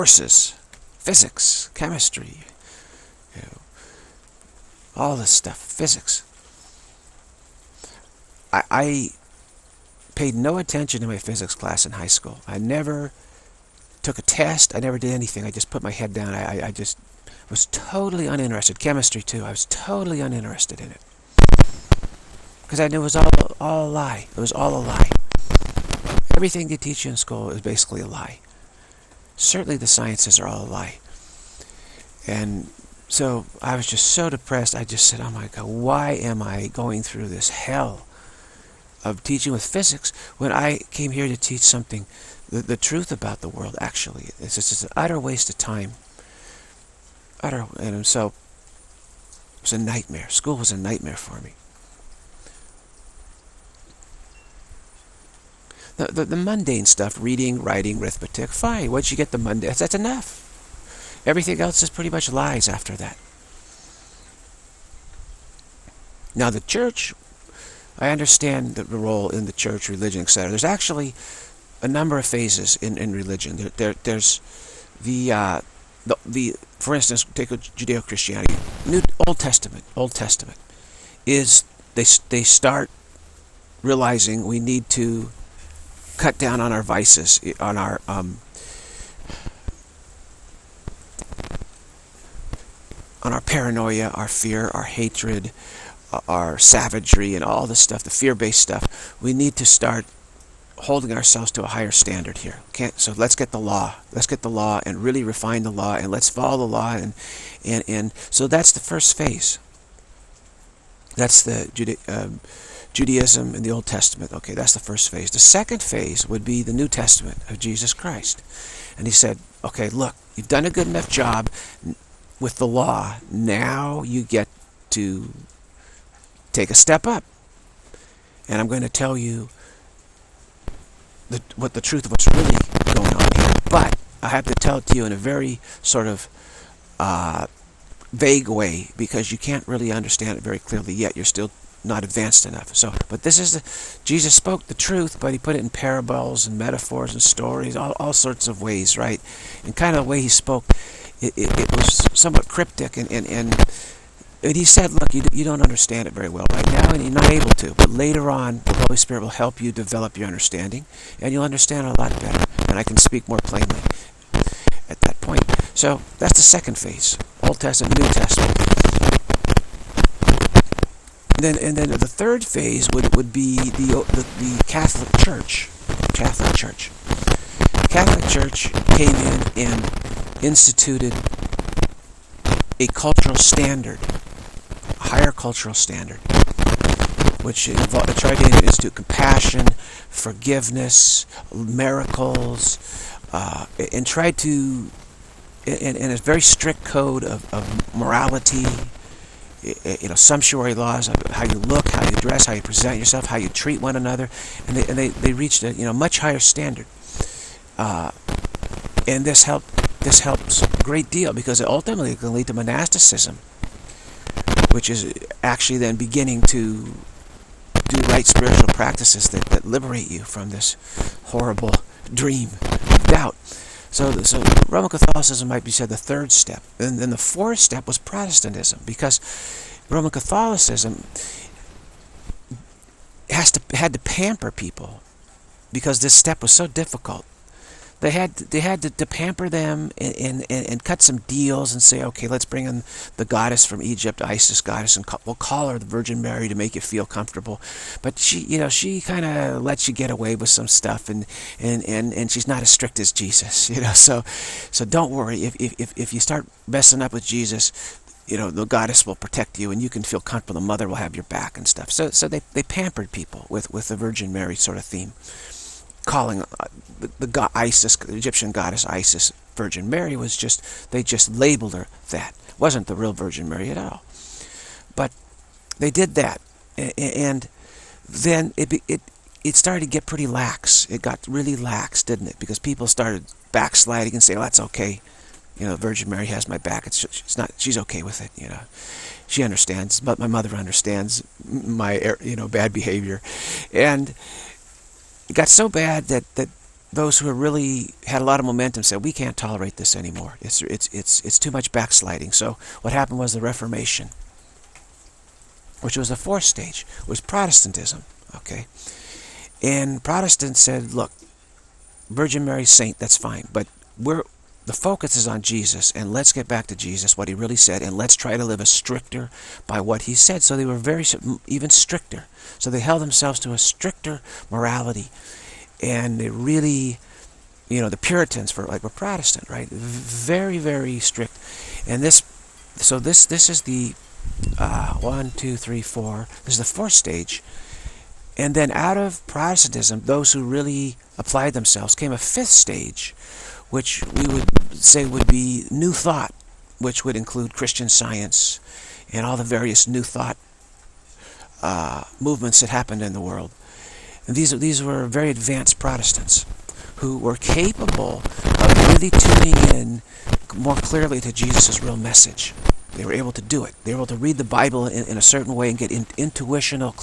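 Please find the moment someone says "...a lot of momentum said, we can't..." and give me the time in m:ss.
4:58.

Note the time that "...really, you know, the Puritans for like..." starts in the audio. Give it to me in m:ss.
5:26.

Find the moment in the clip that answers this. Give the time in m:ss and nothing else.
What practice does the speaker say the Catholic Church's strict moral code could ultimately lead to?
3:32.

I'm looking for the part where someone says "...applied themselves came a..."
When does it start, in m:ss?
5:41.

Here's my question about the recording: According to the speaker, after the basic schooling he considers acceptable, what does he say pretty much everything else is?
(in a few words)
lies.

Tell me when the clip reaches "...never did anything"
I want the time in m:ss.
0:14.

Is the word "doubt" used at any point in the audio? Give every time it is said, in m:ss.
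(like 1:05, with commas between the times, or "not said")
3:43.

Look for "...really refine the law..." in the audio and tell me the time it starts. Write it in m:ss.
1:45.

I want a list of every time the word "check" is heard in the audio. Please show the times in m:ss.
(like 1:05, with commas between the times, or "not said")
not said.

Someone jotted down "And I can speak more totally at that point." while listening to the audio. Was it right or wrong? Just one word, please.
wrong.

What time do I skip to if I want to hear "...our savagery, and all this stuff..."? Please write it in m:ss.
1:36.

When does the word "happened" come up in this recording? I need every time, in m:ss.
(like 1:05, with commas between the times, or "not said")
5:02, 5:52.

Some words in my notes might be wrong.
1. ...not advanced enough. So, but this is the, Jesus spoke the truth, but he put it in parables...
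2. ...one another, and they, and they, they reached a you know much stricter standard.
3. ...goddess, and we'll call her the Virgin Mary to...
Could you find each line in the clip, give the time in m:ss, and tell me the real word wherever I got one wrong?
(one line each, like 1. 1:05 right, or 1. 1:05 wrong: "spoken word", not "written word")
1. 2:21 right
2. 3:23 wrong: "higher", not "stricter"
3. 4:04 right.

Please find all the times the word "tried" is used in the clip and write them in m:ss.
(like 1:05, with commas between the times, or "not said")
3:08, 3:14.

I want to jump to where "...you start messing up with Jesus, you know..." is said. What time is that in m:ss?
4:16.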